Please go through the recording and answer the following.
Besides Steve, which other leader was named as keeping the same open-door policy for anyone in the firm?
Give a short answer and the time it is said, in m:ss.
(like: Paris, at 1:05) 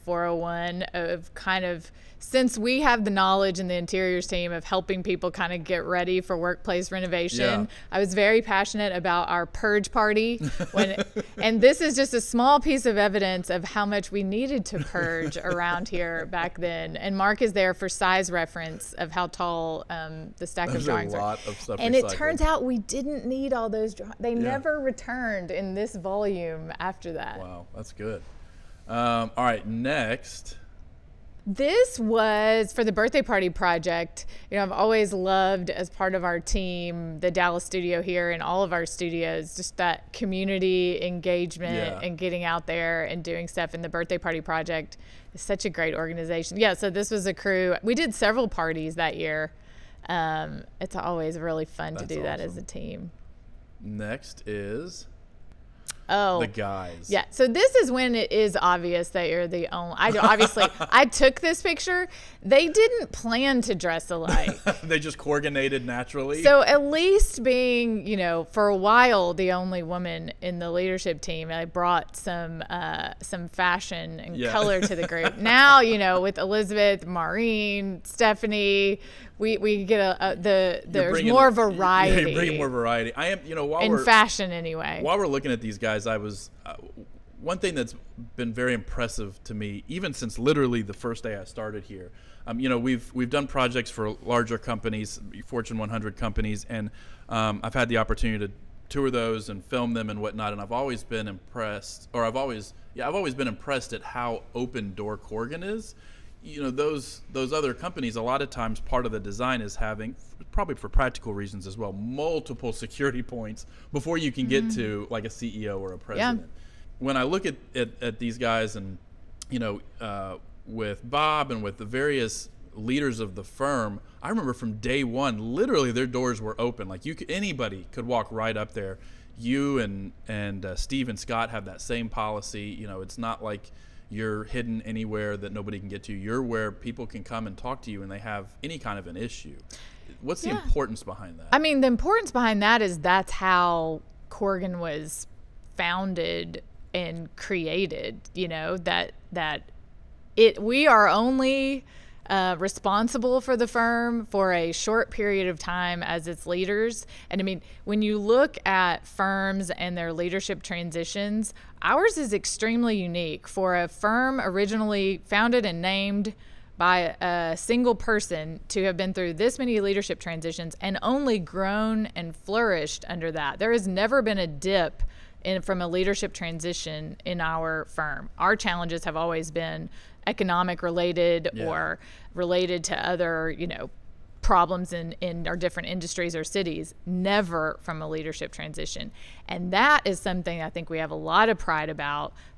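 Scott, at 2:11.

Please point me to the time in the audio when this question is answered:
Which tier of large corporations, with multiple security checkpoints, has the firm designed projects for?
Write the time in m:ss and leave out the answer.
1:35.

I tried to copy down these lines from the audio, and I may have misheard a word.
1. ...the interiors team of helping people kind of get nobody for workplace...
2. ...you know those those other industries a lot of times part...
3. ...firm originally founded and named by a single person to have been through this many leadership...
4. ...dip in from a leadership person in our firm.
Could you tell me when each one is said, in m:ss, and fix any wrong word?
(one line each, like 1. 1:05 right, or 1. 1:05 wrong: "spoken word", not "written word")
1. 0:03 wrong: "ready", not "nobody"
2. 1:46 wrong: "companies", not "industries"
3. 2:43 right
4. 2:54 wrong: "transition", not "person".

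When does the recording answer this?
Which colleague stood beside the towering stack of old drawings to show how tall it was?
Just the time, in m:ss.
0:17.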